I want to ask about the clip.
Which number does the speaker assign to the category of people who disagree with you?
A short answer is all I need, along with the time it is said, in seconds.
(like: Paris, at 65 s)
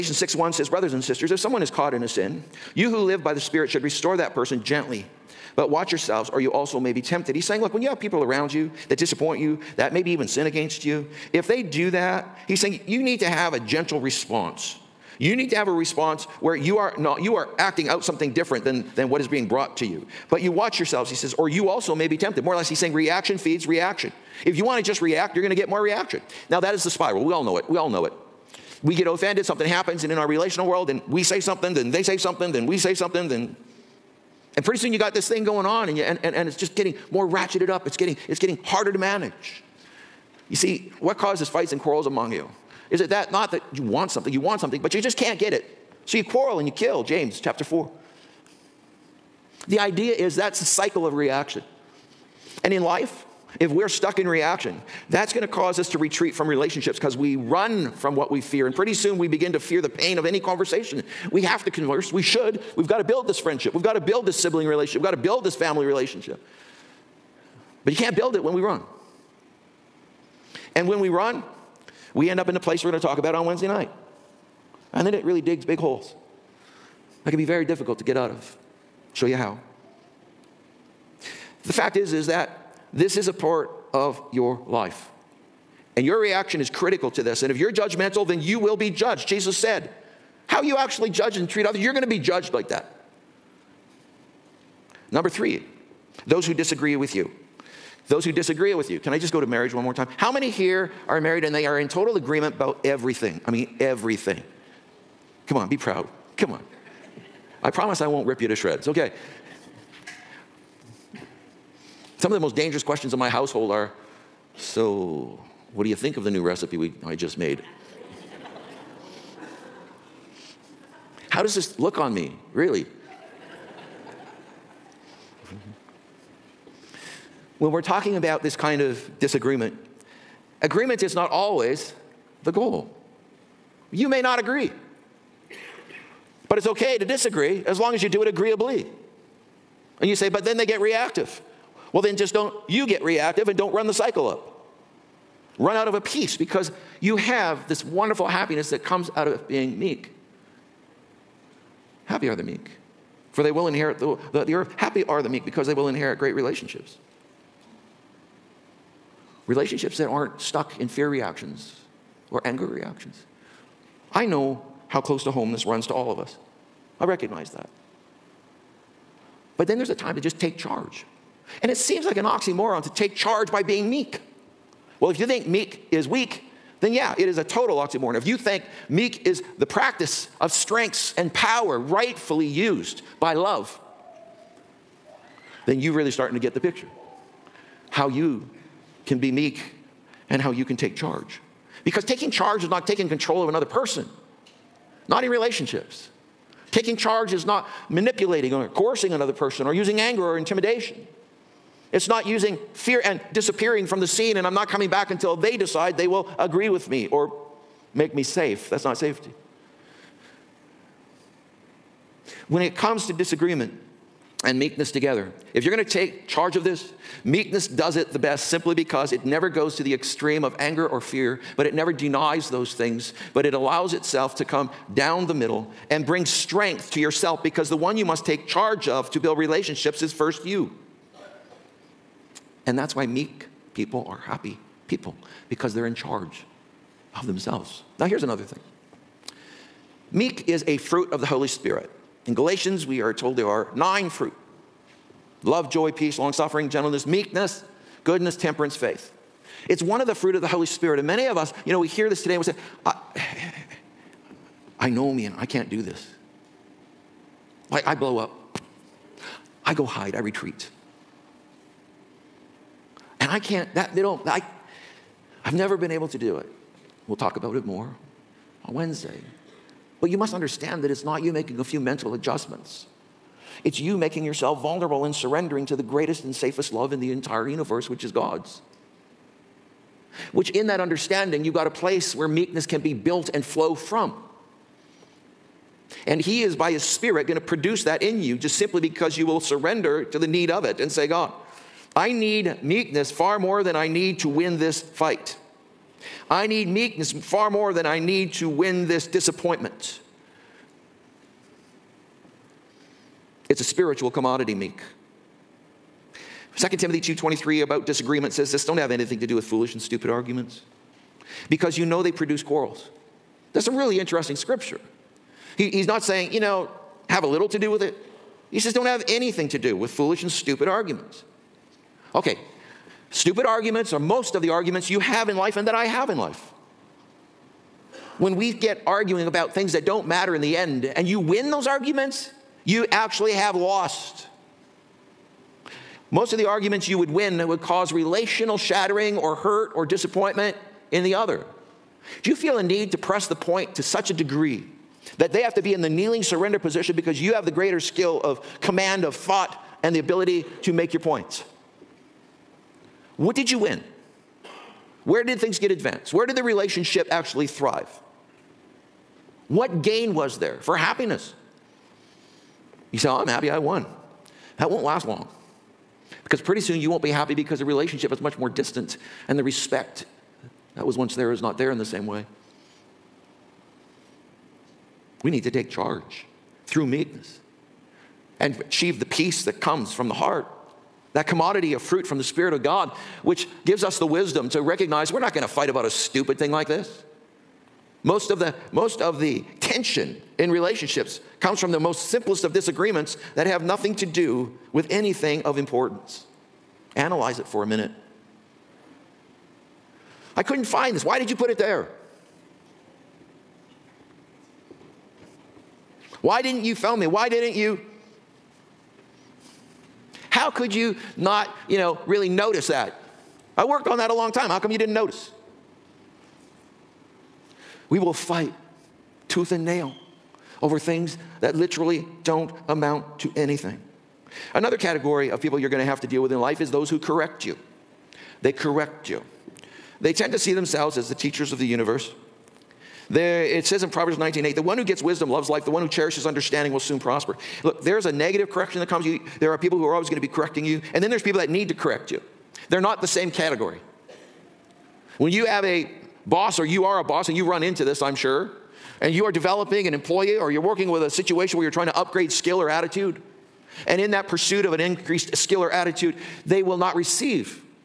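3, at 95 s.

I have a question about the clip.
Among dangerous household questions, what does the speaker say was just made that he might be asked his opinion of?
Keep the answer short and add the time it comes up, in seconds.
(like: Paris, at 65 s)
new recipe, at 116 s.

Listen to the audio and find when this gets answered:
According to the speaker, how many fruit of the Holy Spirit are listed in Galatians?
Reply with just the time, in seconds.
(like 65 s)
243 s.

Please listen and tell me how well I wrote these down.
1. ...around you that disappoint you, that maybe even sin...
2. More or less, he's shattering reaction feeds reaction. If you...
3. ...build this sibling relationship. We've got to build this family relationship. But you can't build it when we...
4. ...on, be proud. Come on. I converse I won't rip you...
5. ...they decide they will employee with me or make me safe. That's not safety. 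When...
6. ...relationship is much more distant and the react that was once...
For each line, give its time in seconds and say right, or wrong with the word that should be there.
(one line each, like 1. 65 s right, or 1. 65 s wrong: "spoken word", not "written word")
1. 8 s right
2. 22 s wrong: "saying", not "shattering"
3. 63 s right
4. 105 s wrong: "promise", not "converse"
5. 205 s wrong: "agree", not "employee"
6. 367 s wrong: "respect", not "react".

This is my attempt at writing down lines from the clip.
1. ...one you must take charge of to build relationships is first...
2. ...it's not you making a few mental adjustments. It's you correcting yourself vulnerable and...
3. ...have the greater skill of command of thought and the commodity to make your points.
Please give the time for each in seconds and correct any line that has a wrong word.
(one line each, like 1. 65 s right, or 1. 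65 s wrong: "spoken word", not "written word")
1. 227 s right
2. 270 s wrong: "making", not "correcting"
3. 347 s wrong: "ability", not "commodity".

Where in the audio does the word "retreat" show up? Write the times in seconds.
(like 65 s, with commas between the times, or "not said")
55 s, 260 s.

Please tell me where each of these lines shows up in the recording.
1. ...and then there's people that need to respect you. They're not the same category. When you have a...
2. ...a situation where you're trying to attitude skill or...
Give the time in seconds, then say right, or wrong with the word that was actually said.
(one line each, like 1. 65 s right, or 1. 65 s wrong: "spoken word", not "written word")
1. 440 s wrong: "correct", not "respect"
2. 451 s wrong: "upgrade", not "attitude".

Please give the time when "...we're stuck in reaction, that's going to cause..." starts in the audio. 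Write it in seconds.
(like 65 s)
53 s.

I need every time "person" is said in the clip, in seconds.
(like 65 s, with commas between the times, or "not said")
4 s, 193 s, 199 s.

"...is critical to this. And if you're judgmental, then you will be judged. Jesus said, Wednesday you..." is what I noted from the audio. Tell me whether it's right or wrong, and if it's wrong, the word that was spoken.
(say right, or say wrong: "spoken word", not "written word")
wrong: "How", not "Wednesday".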